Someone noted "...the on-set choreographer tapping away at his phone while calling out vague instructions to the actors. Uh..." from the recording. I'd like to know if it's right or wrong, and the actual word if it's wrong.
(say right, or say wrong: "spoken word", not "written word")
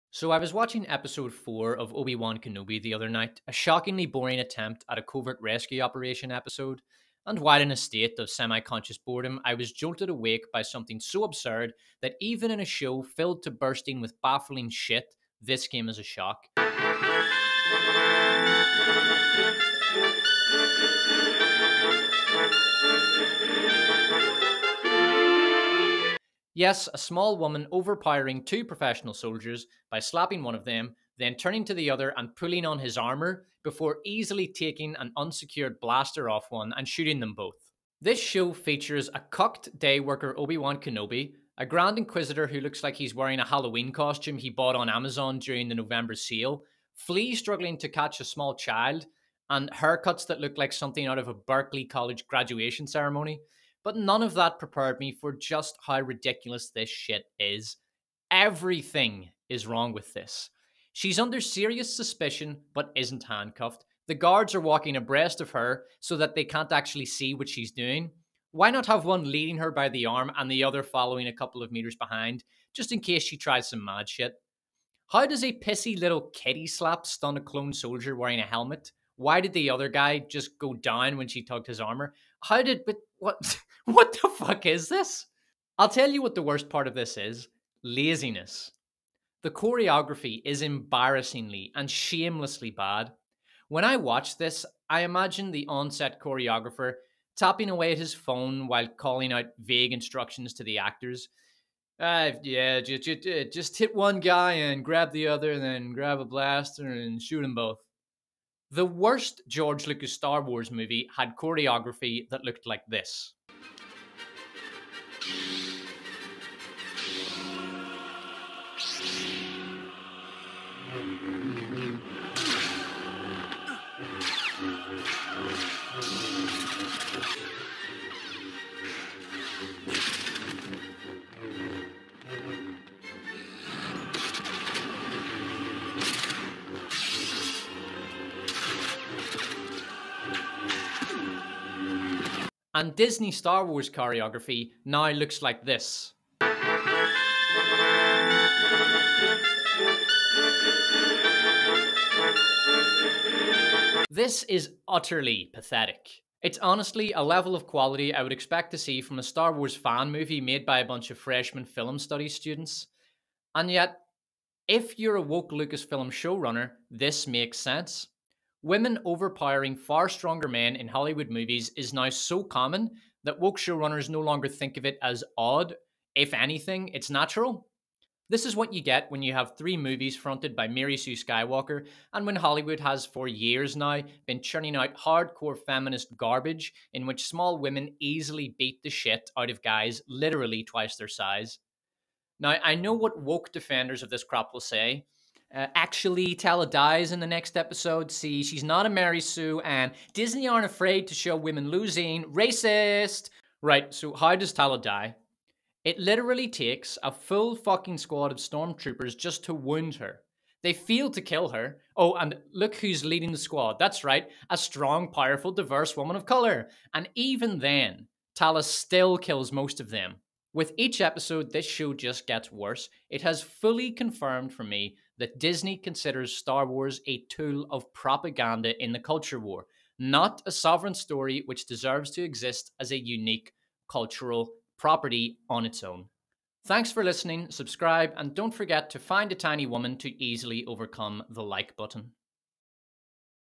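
right.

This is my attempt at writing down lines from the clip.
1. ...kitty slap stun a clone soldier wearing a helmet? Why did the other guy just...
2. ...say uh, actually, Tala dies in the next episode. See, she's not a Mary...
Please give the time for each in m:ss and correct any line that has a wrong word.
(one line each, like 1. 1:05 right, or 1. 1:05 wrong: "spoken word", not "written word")
1. 1:16 right
2. 3:14 right.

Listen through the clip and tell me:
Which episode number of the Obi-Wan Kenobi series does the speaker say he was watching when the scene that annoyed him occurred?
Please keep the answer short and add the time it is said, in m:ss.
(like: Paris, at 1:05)
4, at 0:00.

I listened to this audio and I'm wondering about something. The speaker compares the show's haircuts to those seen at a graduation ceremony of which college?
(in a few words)
Berkeley College.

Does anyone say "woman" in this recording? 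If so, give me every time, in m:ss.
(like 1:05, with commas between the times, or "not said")
0:27, 3:35, 3:59.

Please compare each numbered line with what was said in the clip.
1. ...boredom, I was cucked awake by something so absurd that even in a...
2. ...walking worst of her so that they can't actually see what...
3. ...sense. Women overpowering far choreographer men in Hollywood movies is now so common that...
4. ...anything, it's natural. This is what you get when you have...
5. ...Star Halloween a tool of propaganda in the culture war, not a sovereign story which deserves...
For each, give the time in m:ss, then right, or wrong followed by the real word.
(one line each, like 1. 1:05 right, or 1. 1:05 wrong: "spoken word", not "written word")
1. 0:08 wrong: "jolted", not "cucked"
2. 1:04 wrong: "abreast", not "worst"
3. 2:47 wrong: "stronger", not "choreographer"
4. 2:56 right
5. 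3:46 wrong: "Wars", not "Halloween".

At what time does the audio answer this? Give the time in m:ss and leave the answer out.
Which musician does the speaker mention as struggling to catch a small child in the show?
0:46.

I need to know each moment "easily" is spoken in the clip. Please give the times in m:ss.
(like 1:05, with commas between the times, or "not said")
0:34, 3:07, 4:00.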